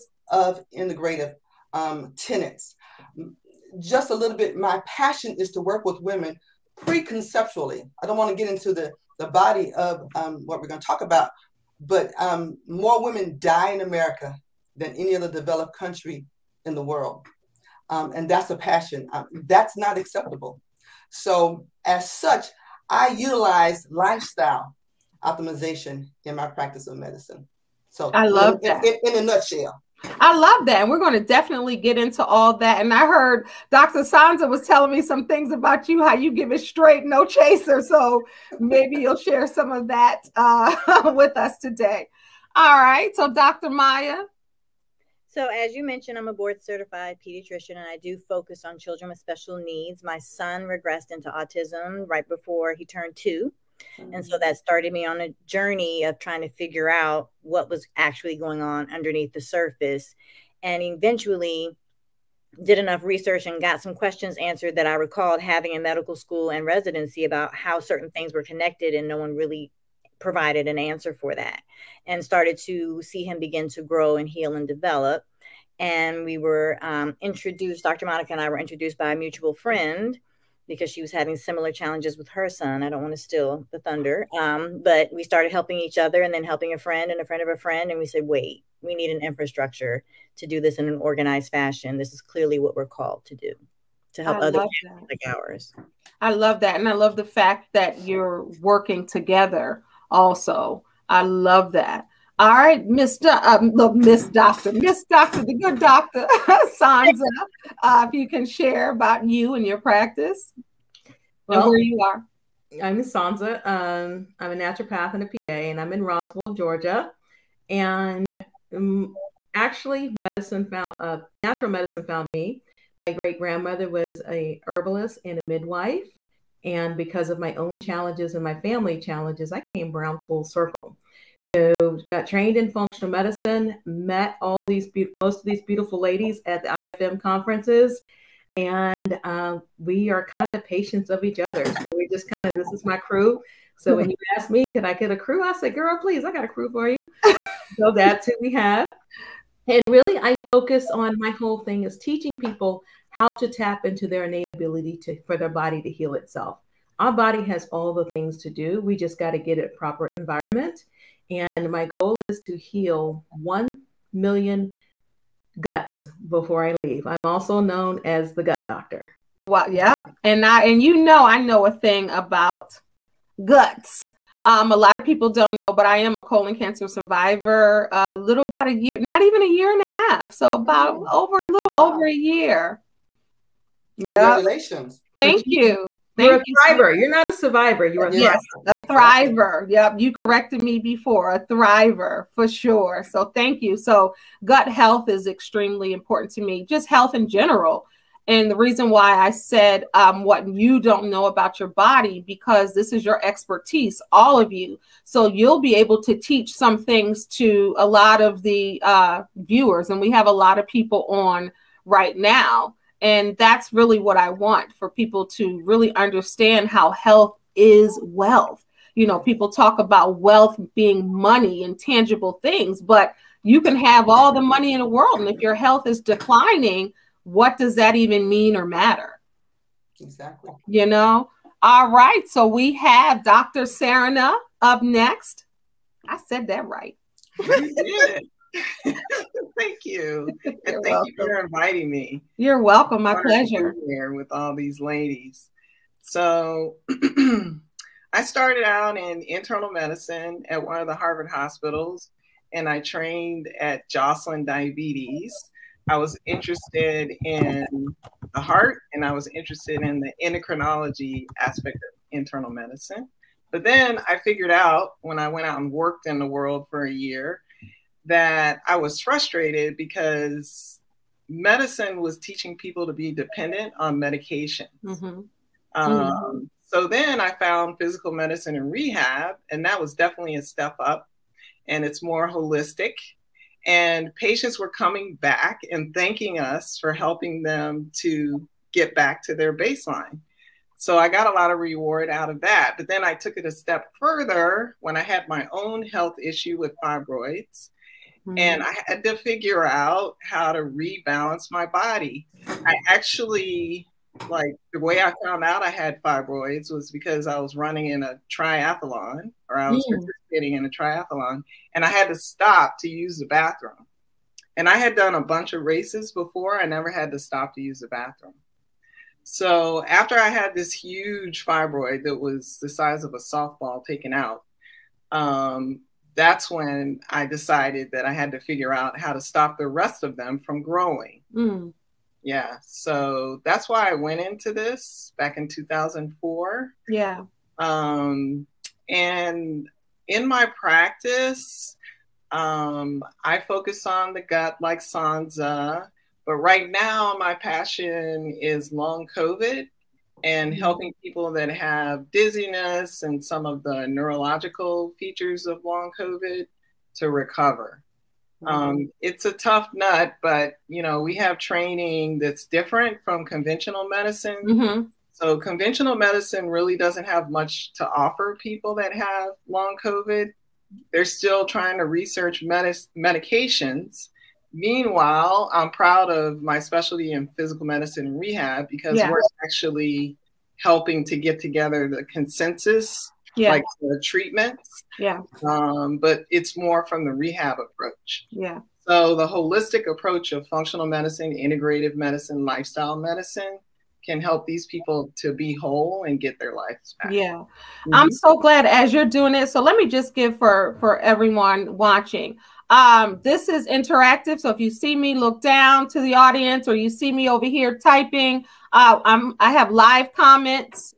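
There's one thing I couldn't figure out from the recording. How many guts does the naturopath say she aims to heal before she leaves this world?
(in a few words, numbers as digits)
1 million.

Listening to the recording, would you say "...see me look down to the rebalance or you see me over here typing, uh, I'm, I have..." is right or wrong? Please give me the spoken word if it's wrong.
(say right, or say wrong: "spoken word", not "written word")
wrong: "audience", not "rebalance".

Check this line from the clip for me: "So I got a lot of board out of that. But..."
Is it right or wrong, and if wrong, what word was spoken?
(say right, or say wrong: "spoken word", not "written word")
wrong: "reward", not "board".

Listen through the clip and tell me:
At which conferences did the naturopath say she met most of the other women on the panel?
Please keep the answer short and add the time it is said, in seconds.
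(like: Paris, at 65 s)
IFM conferences, at 136 s.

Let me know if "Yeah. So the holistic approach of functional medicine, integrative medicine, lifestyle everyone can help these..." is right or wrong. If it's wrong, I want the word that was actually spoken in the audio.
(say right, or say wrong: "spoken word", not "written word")
wrong: "medicine", not "everyone".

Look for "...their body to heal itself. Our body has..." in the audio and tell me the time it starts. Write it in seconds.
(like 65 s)
155 s.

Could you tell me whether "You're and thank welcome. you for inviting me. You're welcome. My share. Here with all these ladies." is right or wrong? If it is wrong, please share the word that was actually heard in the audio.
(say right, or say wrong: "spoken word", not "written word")
wrong: "pleasure", not "share".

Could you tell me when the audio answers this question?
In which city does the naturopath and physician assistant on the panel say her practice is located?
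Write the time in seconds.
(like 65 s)
116 s.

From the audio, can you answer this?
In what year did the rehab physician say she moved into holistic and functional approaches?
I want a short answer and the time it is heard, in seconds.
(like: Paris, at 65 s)
2004, at 335 s.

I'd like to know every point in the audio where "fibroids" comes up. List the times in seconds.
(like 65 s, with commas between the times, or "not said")
296 s, 306 s, 321 s.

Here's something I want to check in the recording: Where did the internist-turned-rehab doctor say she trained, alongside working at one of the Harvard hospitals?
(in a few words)
Jocelyn Diabetes.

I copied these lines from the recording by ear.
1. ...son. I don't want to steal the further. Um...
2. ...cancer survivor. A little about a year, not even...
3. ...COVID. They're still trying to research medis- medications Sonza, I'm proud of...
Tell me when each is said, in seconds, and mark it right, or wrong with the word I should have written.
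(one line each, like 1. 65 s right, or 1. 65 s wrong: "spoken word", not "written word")
1. 82 s wrong: "thunder", not "further"
2. 176 s right
3. 369 s wrong: "Meanwhile", not "Sonza".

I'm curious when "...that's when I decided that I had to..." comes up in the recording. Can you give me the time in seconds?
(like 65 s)
326 s.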